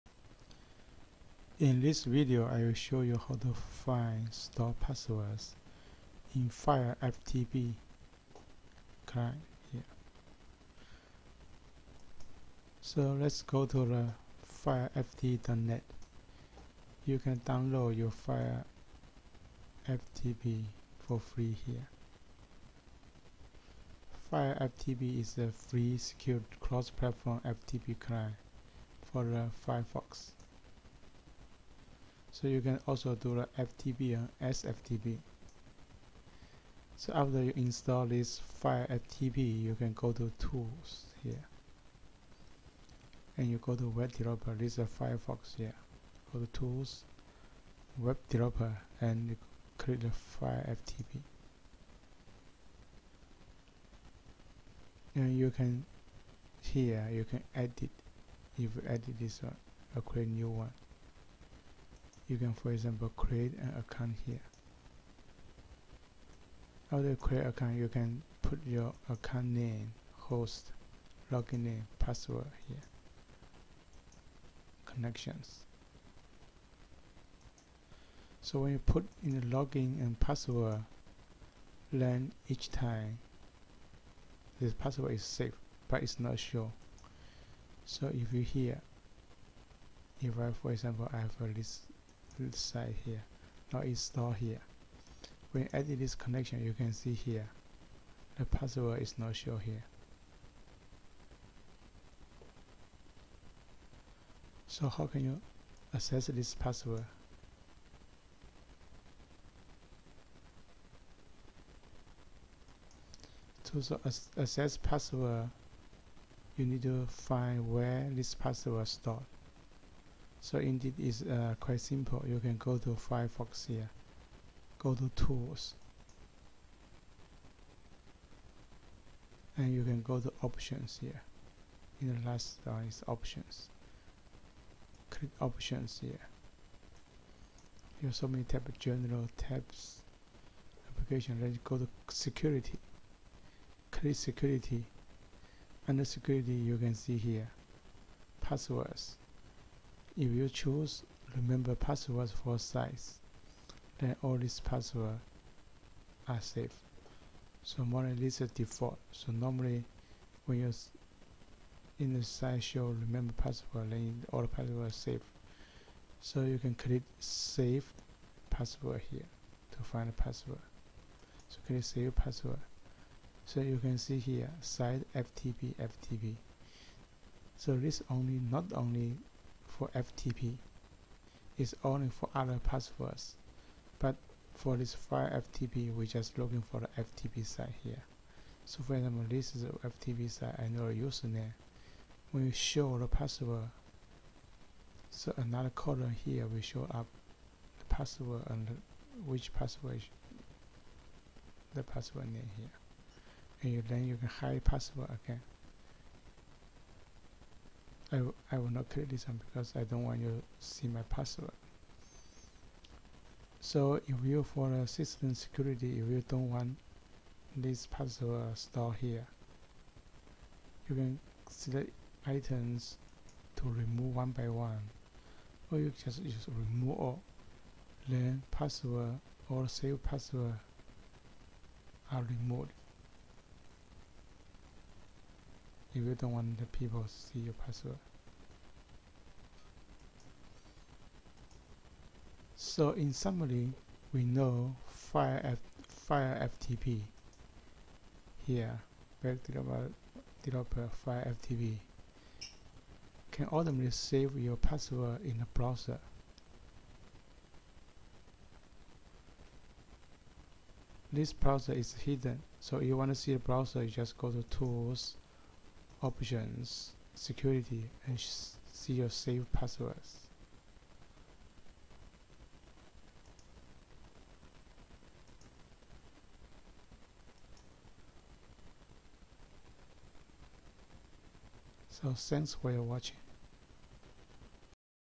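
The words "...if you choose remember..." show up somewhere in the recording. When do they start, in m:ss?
2:30.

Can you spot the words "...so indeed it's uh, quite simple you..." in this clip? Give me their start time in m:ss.
2:00.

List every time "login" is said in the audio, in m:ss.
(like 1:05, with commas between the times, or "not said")
1:11, 1:19.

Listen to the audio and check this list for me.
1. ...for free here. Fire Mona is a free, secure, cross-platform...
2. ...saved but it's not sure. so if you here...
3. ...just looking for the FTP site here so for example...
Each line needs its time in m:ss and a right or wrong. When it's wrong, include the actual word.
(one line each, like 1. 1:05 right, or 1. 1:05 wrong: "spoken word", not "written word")
1. 0:21 wrong: "FTP", not "Mona"
2. 1:25 right
3. 3:06 right.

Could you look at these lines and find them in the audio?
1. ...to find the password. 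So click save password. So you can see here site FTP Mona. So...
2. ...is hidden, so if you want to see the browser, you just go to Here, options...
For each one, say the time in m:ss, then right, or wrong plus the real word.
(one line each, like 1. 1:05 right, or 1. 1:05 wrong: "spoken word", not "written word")
1. 2:49 wrong: "FTP", not "Mona"
2. 4:21 wrong: "Tools", not "Here".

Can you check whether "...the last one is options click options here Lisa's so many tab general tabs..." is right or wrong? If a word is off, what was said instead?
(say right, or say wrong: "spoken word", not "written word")
wrong: "Here", not "Lisa".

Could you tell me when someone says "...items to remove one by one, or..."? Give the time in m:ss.
3:42.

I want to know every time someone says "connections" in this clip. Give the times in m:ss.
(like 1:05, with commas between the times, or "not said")
1:14, 1:36.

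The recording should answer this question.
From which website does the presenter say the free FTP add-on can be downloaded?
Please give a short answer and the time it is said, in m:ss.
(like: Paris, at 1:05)
FireFTP.net, at 0:14.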